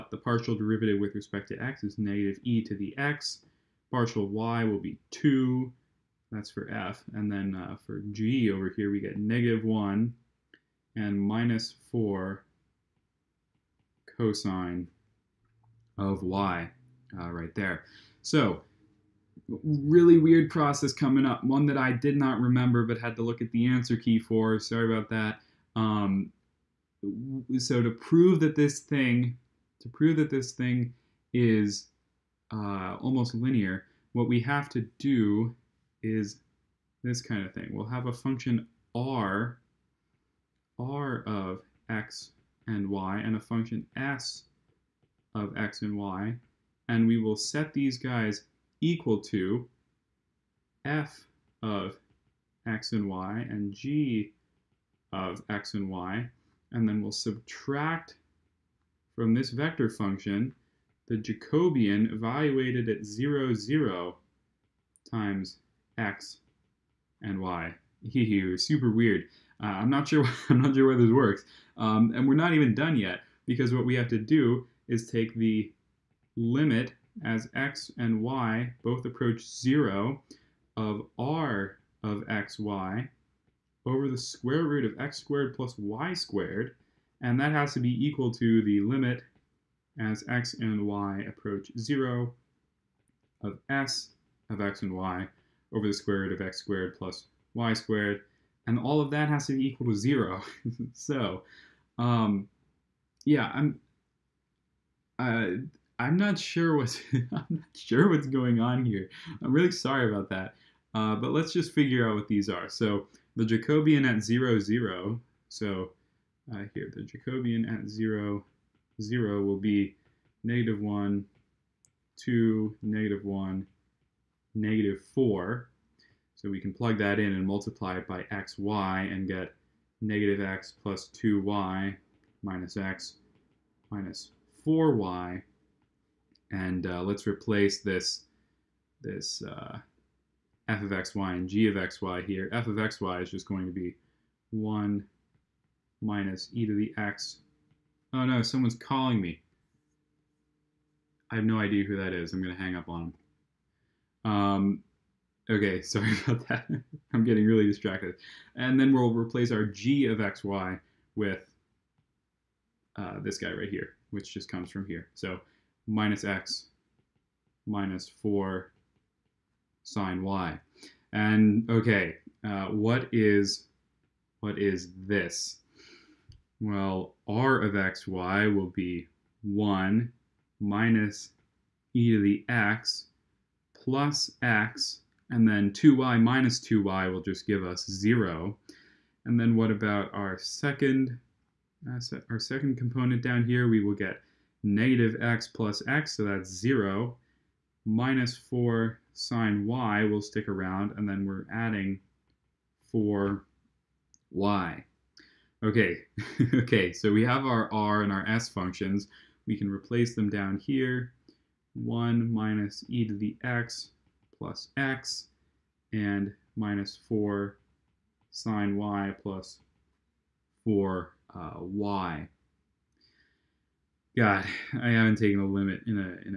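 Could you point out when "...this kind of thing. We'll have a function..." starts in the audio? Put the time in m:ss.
0:37.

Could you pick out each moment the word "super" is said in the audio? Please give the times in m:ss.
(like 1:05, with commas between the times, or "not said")
1:08.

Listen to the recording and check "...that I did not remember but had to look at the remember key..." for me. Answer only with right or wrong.
wrong.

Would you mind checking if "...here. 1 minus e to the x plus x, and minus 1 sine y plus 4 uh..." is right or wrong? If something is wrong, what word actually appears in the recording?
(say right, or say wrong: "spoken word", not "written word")
wrong: "4", not "1".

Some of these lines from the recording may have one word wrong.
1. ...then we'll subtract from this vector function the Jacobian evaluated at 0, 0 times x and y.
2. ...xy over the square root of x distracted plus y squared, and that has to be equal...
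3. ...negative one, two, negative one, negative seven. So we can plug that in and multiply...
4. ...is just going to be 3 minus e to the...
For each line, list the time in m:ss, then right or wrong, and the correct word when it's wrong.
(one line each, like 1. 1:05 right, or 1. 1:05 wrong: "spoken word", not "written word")
1. 0:56 right
2. 1:22 wrong: "squared", not "distracted"
3. 2:00 wrong: "four", not "seven"
4. 2:23 wrong: "1", not "3".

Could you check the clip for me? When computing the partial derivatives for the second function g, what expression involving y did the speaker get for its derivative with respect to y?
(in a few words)
minus 4 cosine of y.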